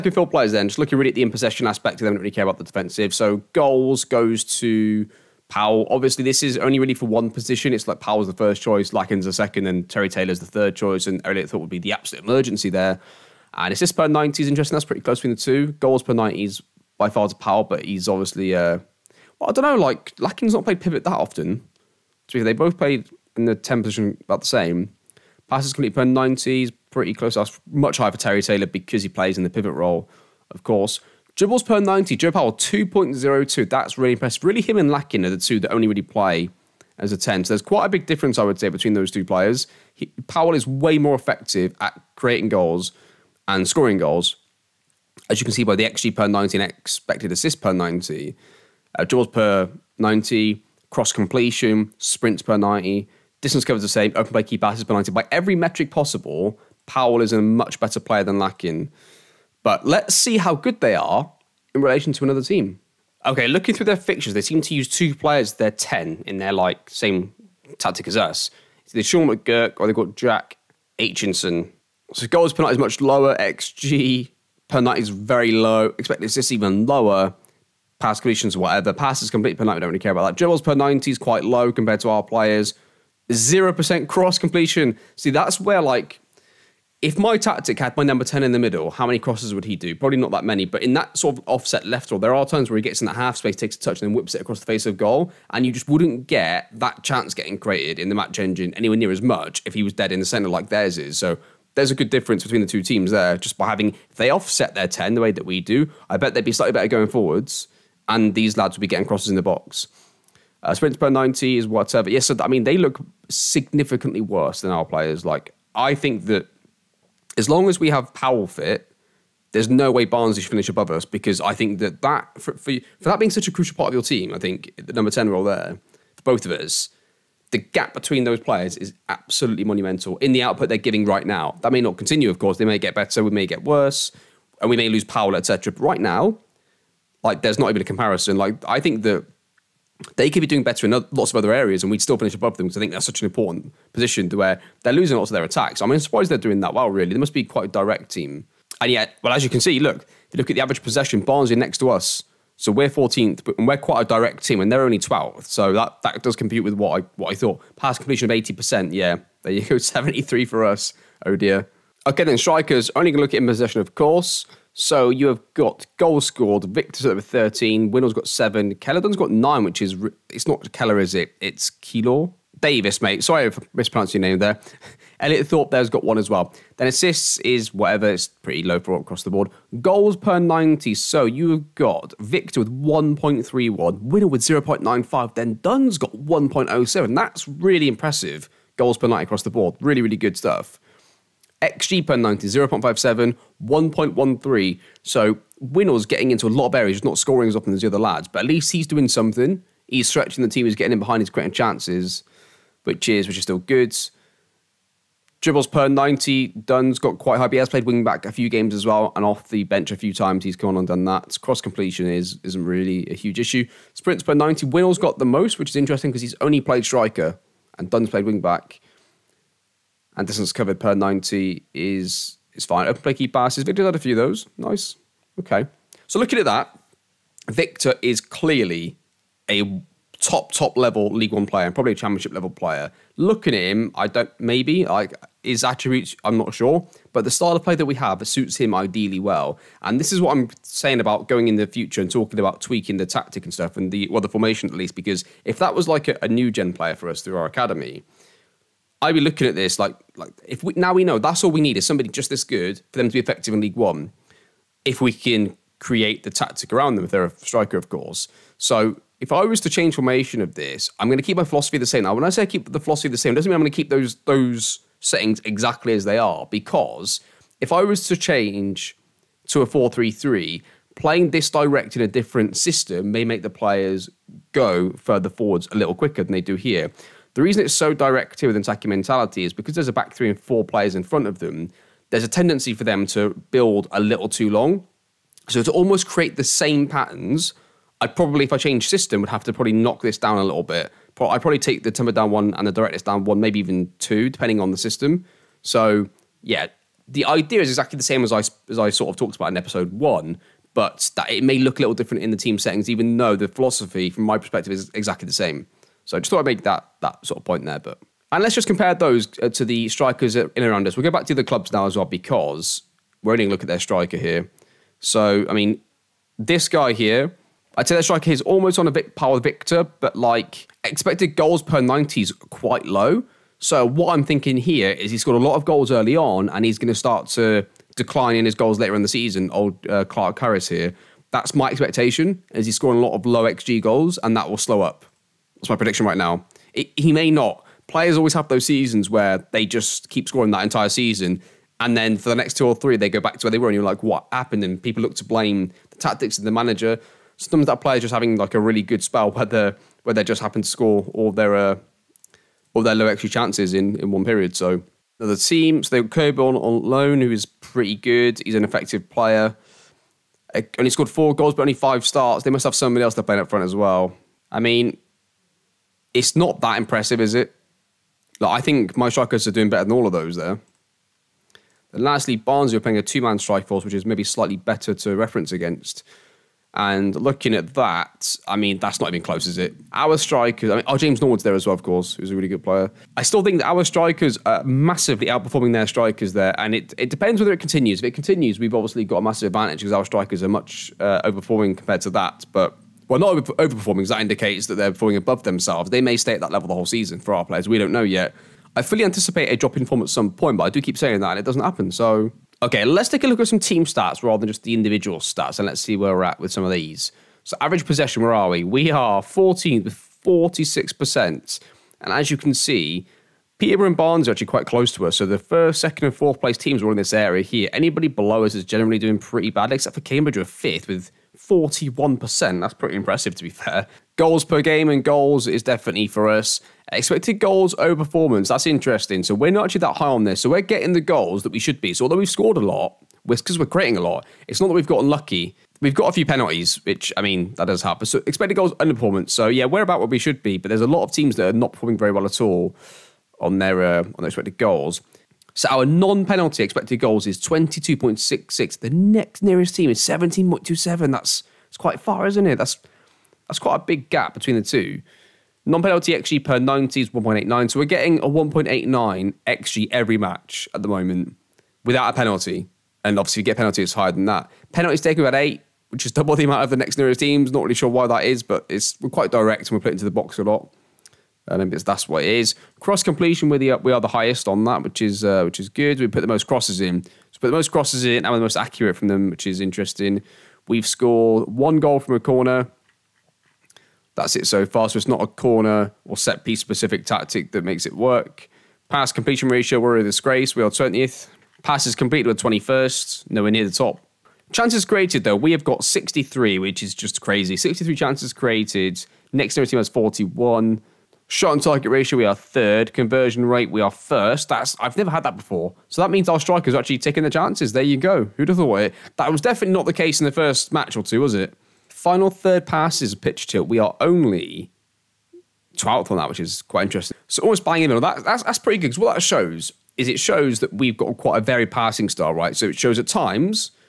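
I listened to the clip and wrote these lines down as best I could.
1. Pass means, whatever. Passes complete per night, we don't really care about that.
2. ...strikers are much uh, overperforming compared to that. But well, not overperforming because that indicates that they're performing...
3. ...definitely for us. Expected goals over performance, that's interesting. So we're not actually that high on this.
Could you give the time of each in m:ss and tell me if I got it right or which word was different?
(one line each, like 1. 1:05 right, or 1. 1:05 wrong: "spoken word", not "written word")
1. 1:17 wrong: "completions", not "means"
2. 6:30 right
3. 7:05 right.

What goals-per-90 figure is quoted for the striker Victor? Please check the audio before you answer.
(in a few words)
1.31.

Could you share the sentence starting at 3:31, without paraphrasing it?
Cross completion is isn't really a huge issue.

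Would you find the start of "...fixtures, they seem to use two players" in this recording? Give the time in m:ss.
1:03.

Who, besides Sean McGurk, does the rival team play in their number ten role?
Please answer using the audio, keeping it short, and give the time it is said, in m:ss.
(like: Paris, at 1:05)
Jack Aitchison, at 1:10.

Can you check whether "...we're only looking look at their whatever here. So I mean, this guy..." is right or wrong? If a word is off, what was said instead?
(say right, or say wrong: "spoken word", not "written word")
wrong: "striker", not "whatever".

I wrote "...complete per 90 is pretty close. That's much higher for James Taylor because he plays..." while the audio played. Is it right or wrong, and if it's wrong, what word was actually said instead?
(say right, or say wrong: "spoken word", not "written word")
wrong: "Terry", not "James".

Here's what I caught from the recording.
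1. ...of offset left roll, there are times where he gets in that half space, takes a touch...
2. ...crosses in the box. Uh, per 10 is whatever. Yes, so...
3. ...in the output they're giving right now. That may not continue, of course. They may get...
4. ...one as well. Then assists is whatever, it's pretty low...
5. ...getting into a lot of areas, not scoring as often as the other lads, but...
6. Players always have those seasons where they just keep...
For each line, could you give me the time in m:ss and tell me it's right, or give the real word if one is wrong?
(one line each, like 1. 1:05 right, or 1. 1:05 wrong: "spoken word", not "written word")
1. 1:31 right
2. 1:49 wrong: "90", not "10"
3. 2:10 right
4. 2:56 right
5. 3:16 right
6. 5:37 right.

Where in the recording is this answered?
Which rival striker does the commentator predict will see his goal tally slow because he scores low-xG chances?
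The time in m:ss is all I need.
5:30.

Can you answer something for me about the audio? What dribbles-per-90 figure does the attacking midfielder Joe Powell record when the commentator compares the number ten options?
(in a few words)
2.02.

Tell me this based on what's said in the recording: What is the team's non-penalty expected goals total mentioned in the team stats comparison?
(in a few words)
22.66.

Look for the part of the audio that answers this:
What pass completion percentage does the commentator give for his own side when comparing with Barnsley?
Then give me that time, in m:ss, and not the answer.
2:39.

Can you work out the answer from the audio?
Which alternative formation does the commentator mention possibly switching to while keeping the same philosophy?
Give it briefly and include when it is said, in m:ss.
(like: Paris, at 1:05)
4-3-3, at 4:29.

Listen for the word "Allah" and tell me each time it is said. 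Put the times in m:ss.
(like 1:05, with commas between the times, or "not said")
not said.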